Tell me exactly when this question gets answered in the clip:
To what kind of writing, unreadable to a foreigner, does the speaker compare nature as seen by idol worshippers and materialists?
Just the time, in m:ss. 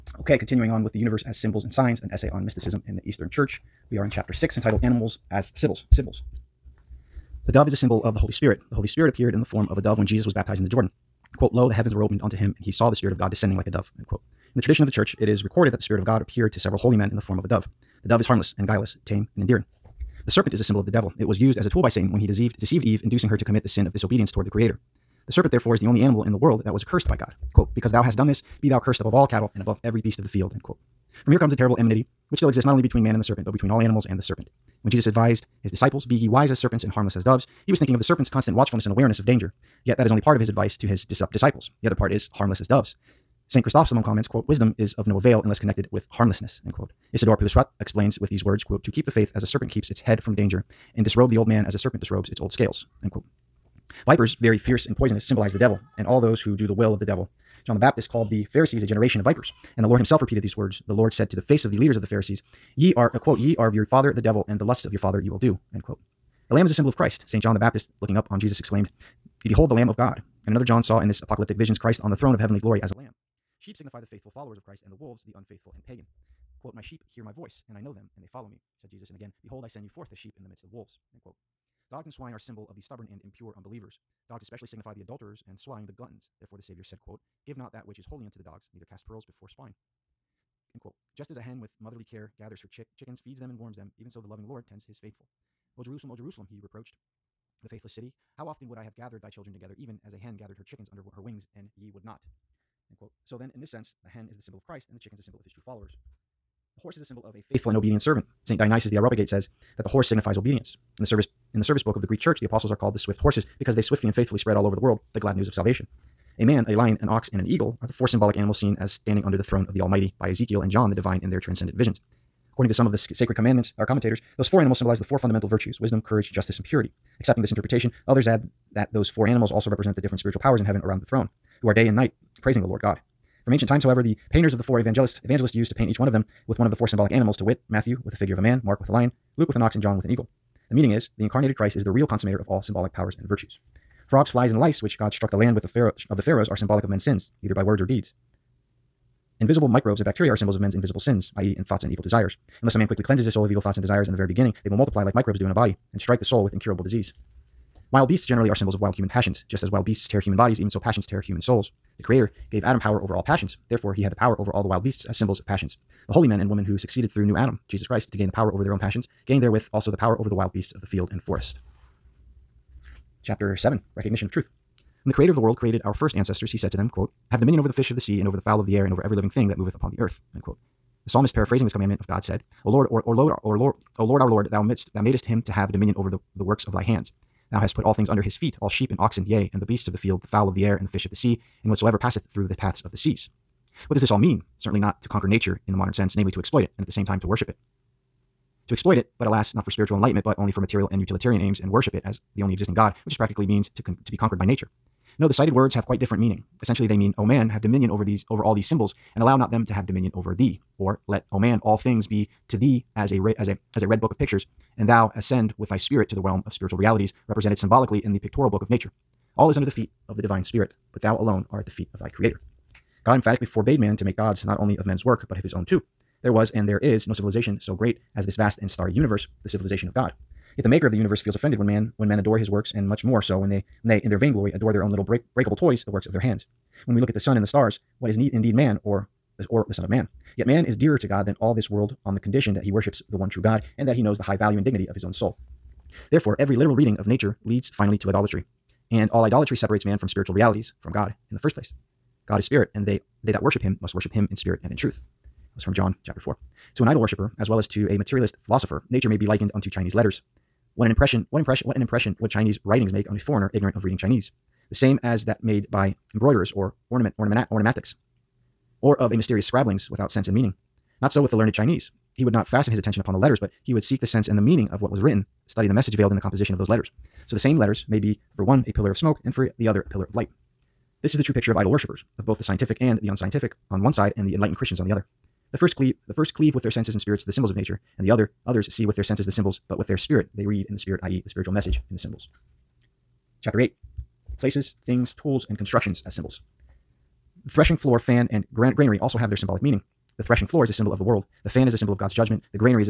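4:19.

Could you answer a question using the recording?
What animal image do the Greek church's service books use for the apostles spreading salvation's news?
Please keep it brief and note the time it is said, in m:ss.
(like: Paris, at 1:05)
swift horses, at 1:52.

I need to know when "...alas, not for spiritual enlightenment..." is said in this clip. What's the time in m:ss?
3:19.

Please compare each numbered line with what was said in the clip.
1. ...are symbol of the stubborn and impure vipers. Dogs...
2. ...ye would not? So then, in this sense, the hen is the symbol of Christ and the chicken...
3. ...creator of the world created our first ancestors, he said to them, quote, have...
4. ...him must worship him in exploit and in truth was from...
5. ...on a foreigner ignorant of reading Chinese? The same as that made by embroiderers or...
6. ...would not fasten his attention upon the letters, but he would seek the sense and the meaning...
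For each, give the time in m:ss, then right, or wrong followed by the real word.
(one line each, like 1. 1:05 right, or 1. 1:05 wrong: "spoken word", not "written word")
1. 1:22 wrong: "unbelievers", not "vipers"
2. 1:41 right
3. 2:55 right
4. 4:13 wrong: "spirit", not "exploit"
5. 4:23 right
6. 4:32 right.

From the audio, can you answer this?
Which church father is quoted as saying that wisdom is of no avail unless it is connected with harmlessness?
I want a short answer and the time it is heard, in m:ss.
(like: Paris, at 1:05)
St. Chrysostom, at 0:43.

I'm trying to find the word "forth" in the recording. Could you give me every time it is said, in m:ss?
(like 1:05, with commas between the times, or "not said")
1:19.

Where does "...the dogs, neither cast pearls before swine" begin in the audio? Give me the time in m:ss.
1:28.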